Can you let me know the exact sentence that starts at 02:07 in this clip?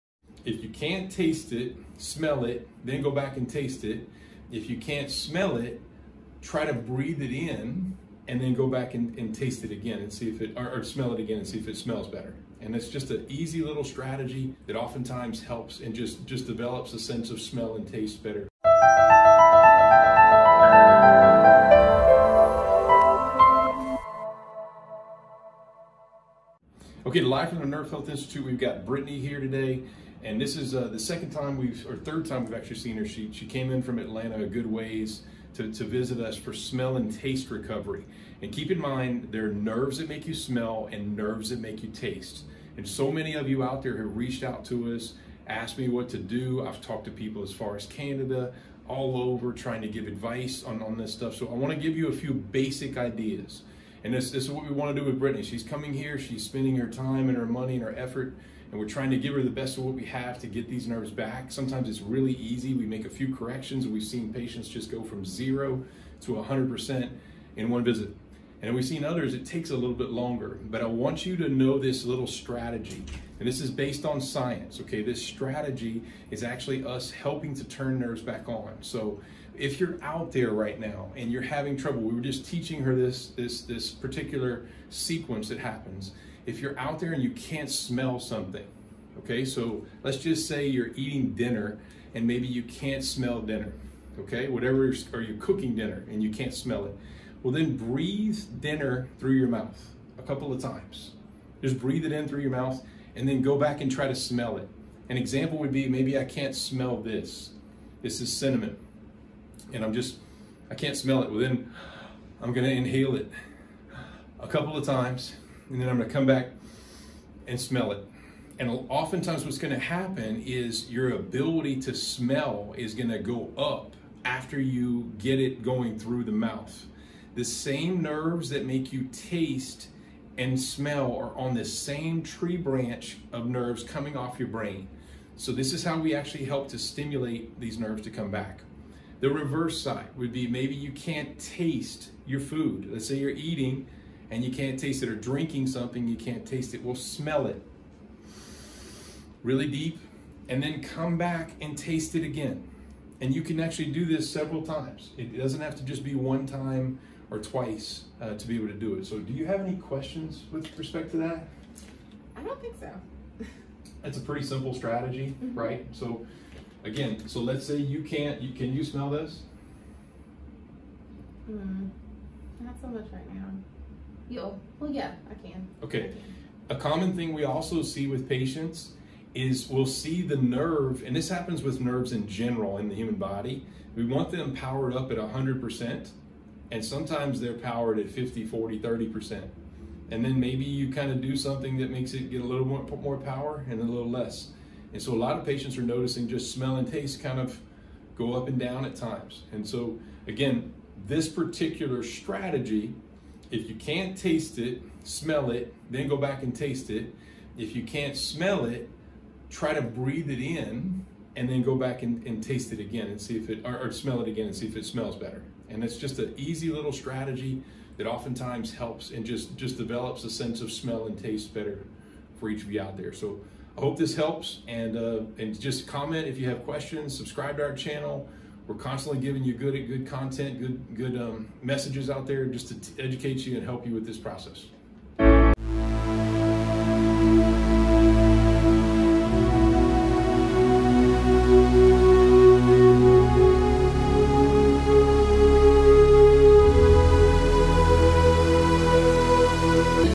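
The same nerves that make you taste and smell are on this same tree branch of nerves coming off your brain.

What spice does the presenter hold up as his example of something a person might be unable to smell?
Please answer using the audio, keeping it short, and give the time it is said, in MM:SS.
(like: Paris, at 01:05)
Cinnamon, at 01:48.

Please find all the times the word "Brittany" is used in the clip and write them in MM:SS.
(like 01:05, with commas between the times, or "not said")
00:28, 00:55.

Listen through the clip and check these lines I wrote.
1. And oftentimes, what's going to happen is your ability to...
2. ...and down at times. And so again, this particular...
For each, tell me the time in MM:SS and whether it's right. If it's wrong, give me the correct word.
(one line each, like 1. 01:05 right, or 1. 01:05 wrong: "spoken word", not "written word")
1. 01:58 right
2. 03:18 right.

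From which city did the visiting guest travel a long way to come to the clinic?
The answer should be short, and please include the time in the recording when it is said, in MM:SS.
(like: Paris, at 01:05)
Atlanta, at 00:33.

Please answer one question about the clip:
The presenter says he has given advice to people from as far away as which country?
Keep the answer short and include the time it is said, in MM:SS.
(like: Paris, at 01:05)
Canada, at 00:47.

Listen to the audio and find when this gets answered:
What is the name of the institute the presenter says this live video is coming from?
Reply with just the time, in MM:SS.
00:27.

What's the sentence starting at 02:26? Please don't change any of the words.
Well, smell it really deep and then come back and taste it again.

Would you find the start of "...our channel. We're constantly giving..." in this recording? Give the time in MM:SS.
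03:47.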